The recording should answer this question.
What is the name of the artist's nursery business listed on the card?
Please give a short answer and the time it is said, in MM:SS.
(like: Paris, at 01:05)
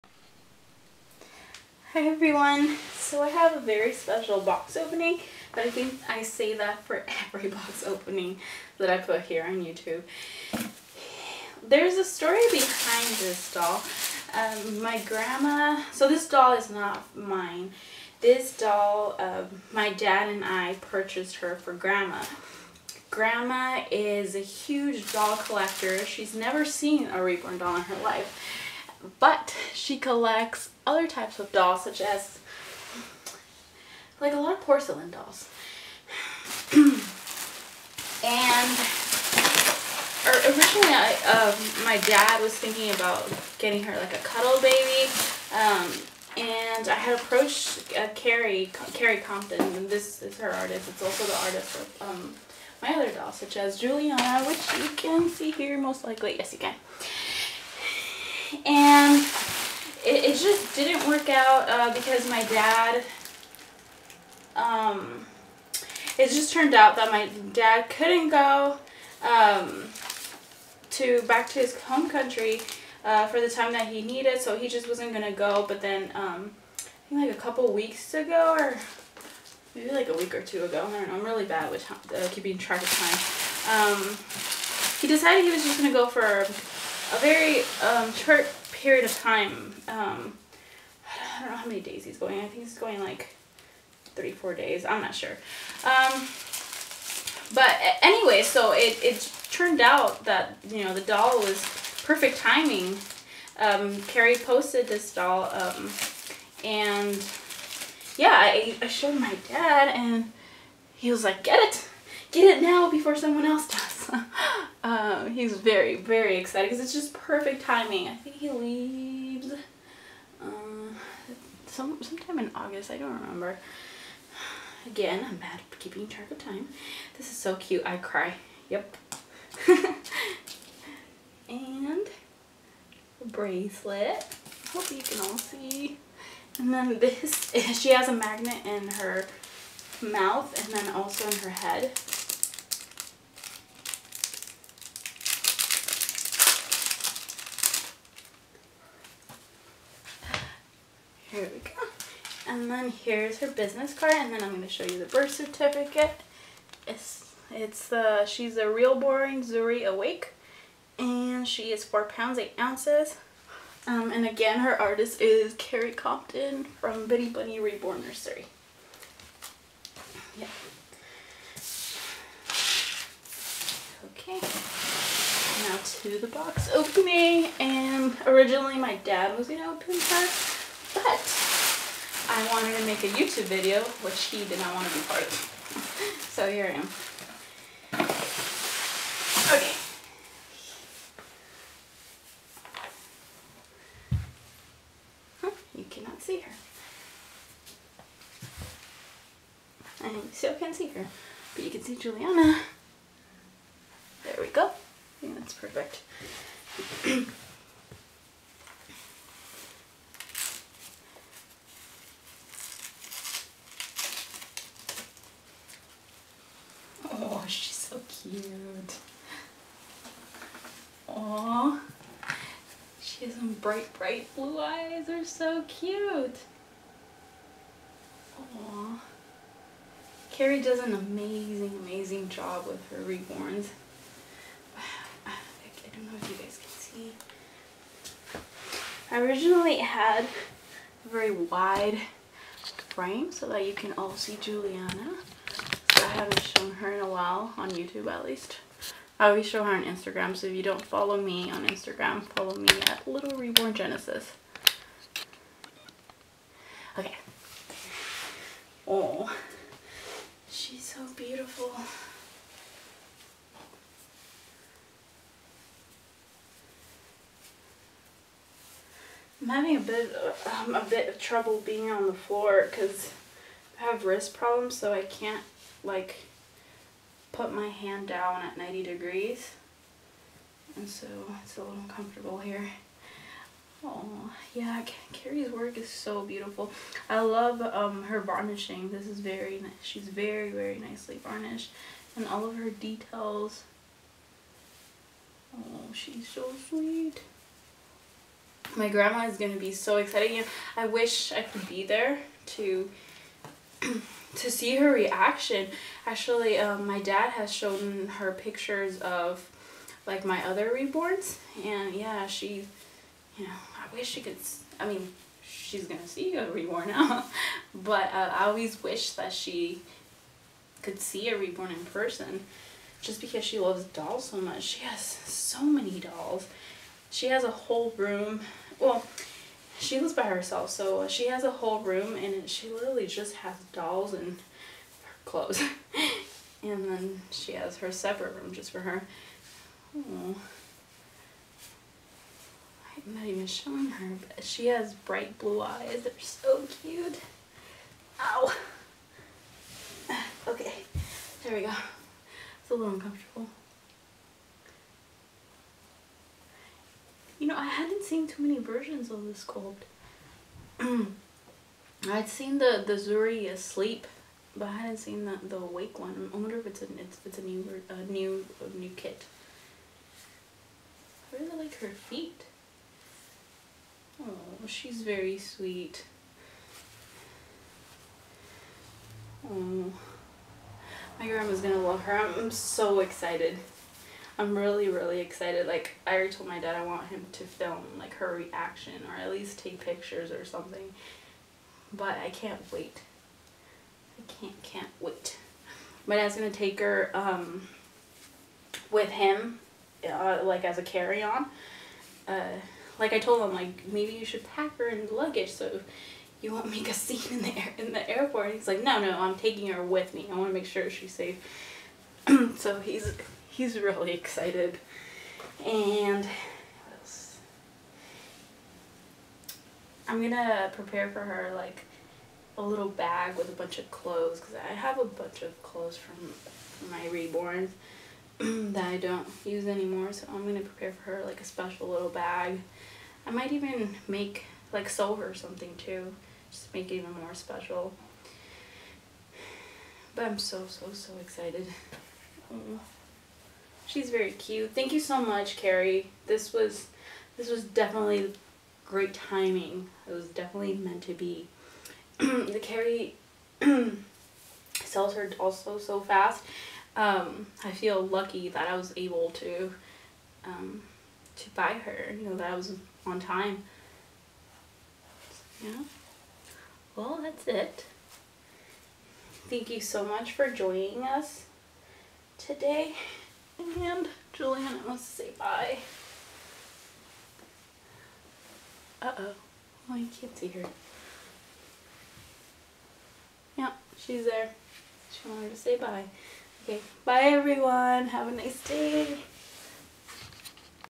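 Bitty Bunny Reborn Nursery, at 02:47.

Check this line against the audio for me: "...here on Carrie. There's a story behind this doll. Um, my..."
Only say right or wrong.
wrong.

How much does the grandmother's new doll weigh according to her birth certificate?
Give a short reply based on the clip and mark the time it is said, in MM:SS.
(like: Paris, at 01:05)
4 pounds 8 ounces, at 02:41.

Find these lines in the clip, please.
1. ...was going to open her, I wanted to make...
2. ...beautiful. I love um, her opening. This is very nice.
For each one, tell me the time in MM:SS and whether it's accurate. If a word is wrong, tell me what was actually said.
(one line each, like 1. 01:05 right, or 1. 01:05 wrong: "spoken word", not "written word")
1. 02:59 right
2. 04:46 wrong: "varnishing", not "opening".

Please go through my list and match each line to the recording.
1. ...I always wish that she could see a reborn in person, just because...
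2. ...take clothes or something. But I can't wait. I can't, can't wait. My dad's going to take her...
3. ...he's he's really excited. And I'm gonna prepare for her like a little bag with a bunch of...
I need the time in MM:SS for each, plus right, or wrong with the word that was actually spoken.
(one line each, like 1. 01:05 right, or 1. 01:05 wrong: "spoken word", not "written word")
1. 05:18 right
2. 06:29 wrong: "pictures", not "clothes"
3. 06:52 right.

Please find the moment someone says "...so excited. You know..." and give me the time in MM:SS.
04:59.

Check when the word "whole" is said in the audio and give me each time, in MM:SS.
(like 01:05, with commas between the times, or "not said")
05:27, 05:31.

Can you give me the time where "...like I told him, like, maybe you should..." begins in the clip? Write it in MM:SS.
06:42.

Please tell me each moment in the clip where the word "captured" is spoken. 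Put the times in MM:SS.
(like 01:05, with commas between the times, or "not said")
not said.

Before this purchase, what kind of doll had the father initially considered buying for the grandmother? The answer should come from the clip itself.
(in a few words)
Cuddle baby.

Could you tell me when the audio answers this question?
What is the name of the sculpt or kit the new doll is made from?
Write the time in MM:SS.
02:39.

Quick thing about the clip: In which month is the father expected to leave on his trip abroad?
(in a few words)
August.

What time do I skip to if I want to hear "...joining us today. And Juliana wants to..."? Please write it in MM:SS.
07:50.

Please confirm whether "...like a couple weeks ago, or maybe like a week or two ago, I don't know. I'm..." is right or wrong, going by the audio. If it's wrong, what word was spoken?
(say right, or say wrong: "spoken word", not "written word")
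right.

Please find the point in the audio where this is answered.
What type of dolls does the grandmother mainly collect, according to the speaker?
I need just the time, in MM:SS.
00:34.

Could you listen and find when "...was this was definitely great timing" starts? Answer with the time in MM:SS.
07:26.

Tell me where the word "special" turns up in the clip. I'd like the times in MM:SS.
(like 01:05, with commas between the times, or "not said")
00:03, 07:11, 07:17.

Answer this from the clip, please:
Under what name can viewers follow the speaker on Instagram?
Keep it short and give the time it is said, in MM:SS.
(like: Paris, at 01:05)
Little Reborn Genesis, at 04:13.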